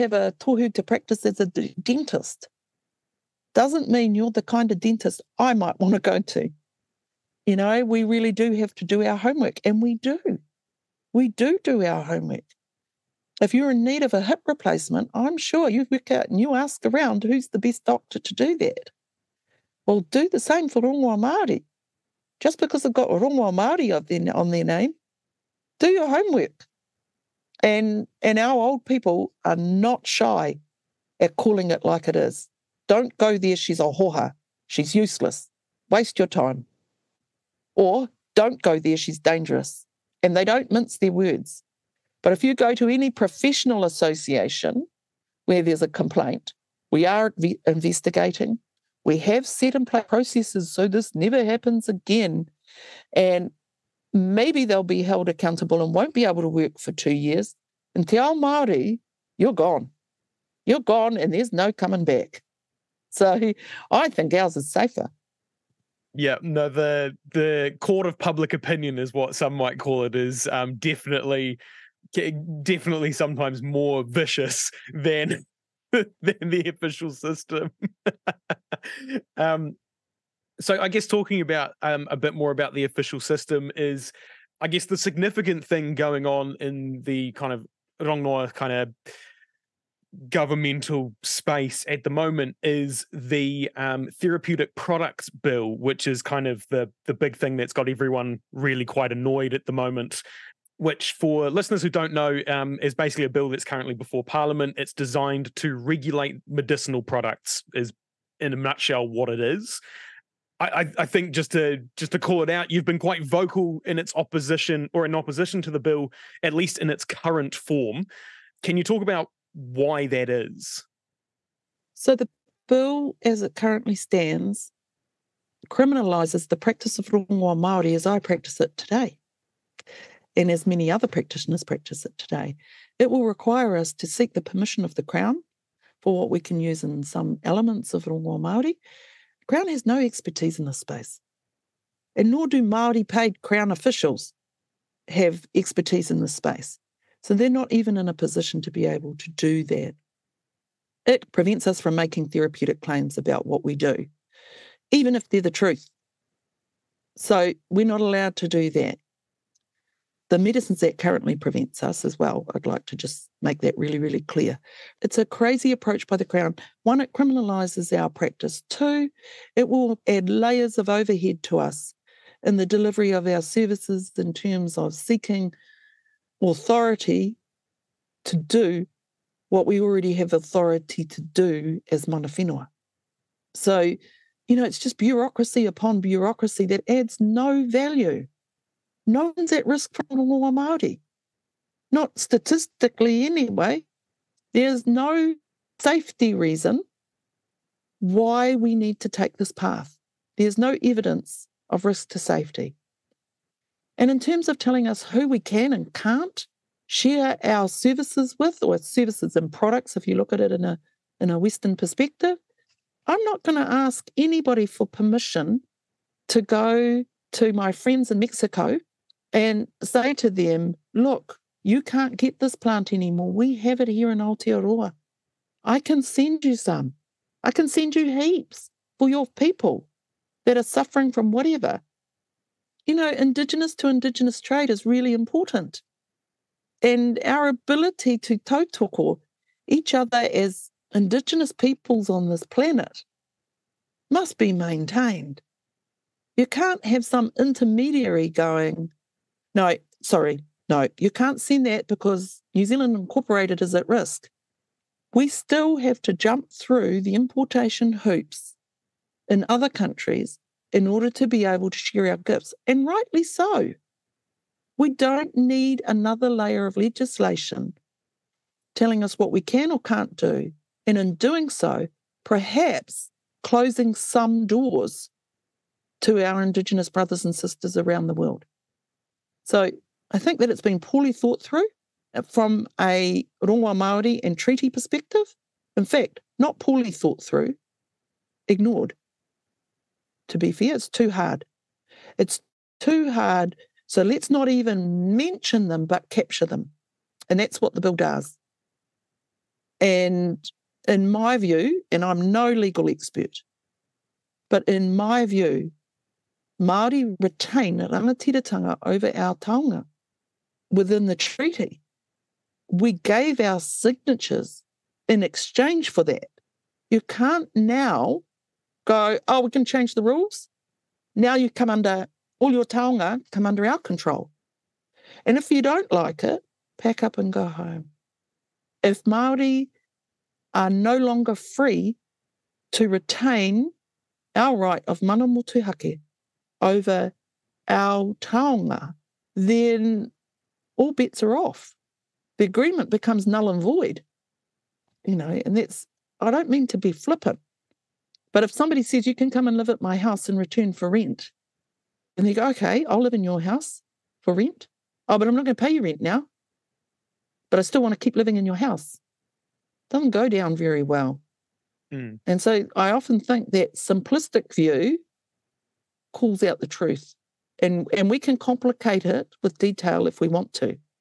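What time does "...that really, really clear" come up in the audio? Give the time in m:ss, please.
2:43.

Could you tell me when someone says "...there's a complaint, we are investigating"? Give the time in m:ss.
0:45.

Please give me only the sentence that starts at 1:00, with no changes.
You're gone and there's no coming back.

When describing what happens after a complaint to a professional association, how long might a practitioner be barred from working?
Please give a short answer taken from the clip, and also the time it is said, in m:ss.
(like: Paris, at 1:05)
2 years, at 0:56.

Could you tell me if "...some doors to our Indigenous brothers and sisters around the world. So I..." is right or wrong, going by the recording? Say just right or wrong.
right.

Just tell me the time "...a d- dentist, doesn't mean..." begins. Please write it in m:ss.
0:01.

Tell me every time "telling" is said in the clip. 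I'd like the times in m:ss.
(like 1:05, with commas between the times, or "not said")
3:24, 4:28.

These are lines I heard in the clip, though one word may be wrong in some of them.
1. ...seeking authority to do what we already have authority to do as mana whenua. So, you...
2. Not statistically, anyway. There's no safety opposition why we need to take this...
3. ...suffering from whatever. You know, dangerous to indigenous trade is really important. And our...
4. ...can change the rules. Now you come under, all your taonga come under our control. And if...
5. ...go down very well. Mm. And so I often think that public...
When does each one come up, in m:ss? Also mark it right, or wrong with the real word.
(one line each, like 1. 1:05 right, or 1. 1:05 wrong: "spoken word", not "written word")
1. 2:54 right
2. 3:11 wrong: "reason", not "opposition"
3. 3:50 wrong: "indigenous", not "dangerous"
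4. 5:19 right
5. 6:00 wrong: "simplistic", not "public".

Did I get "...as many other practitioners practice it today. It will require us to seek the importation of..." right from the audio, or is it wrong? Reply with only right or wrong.
wrong.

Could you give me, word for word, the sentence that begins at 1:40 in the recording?
Which, for listeners who don't know, um, is basically a bill that's currently before Parliament.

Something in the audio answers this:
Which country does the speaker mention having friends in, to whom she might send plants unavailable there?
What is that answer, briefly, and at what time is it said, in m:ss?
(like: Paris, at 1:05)
Mexico, at 3:38.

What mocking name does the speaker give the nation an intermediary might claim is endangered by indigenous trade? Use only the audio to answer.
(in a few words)
New Zealand Incorporated.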